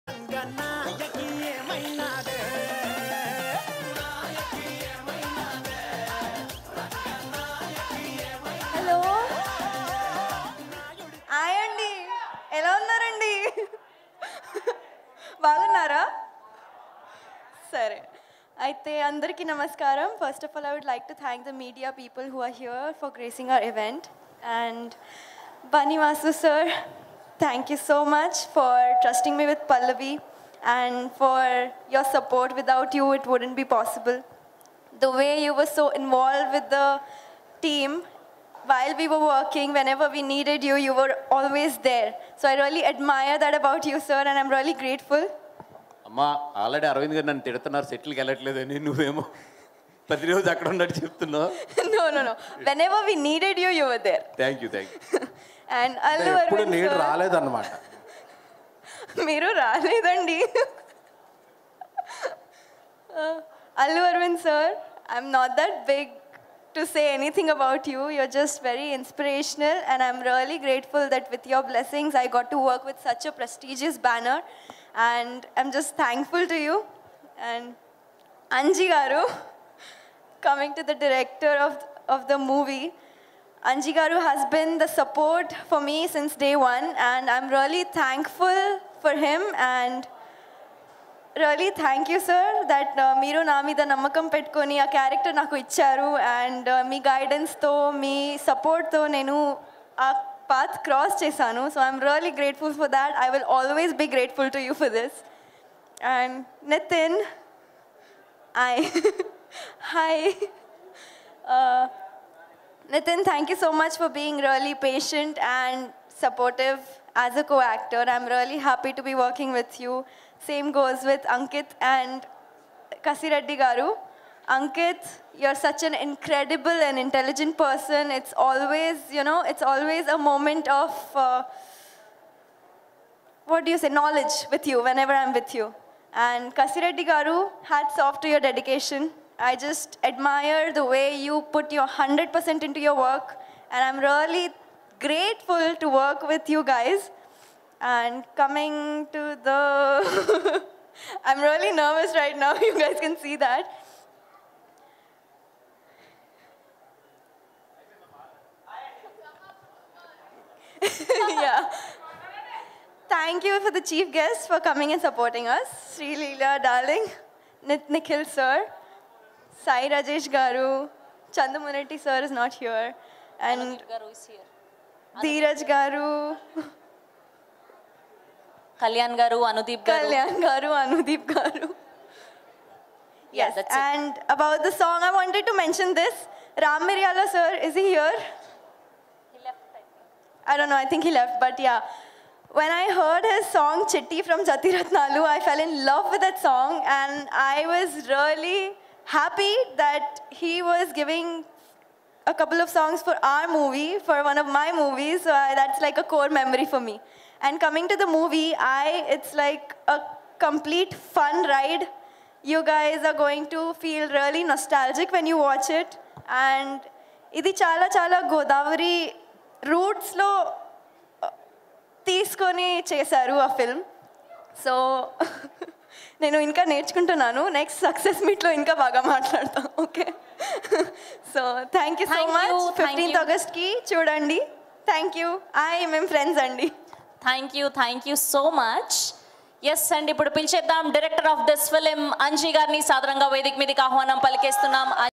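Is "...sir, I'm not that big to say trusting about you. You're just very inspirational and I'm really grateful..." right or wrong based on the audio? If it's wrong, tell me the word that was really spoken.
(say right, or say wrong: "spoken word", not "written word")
wrong: "anything", not "trusting".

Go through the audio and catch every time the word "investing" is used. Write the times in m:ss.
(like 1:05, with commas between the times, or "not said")
not said.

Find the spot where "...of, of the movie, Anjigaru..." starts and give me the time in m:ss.
1:21.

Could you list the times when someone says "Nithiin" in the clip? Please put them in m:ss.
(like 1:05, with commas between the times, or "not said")
1:46, 1:52.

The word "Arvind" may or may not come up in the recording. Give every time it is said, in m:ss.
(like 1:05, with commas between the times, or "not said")
0:56.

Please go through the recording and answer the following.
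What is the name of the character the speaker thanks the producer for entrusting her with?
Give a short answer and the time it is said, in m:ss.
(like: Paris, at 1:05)
Pallavi, at 0:29.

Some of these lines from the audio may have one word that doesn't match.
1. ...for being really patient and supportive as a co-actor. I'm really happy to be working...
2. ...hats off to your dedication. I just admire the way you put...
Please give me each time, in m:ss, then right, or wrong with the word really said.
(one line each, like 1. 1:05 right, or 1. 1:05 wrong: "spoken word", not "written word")
1. 1:53 right
2. 2:17 right.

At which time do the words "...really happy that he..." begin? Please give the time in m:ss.
3:18.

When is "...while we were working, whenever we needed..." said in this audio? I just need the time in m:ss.
0:38.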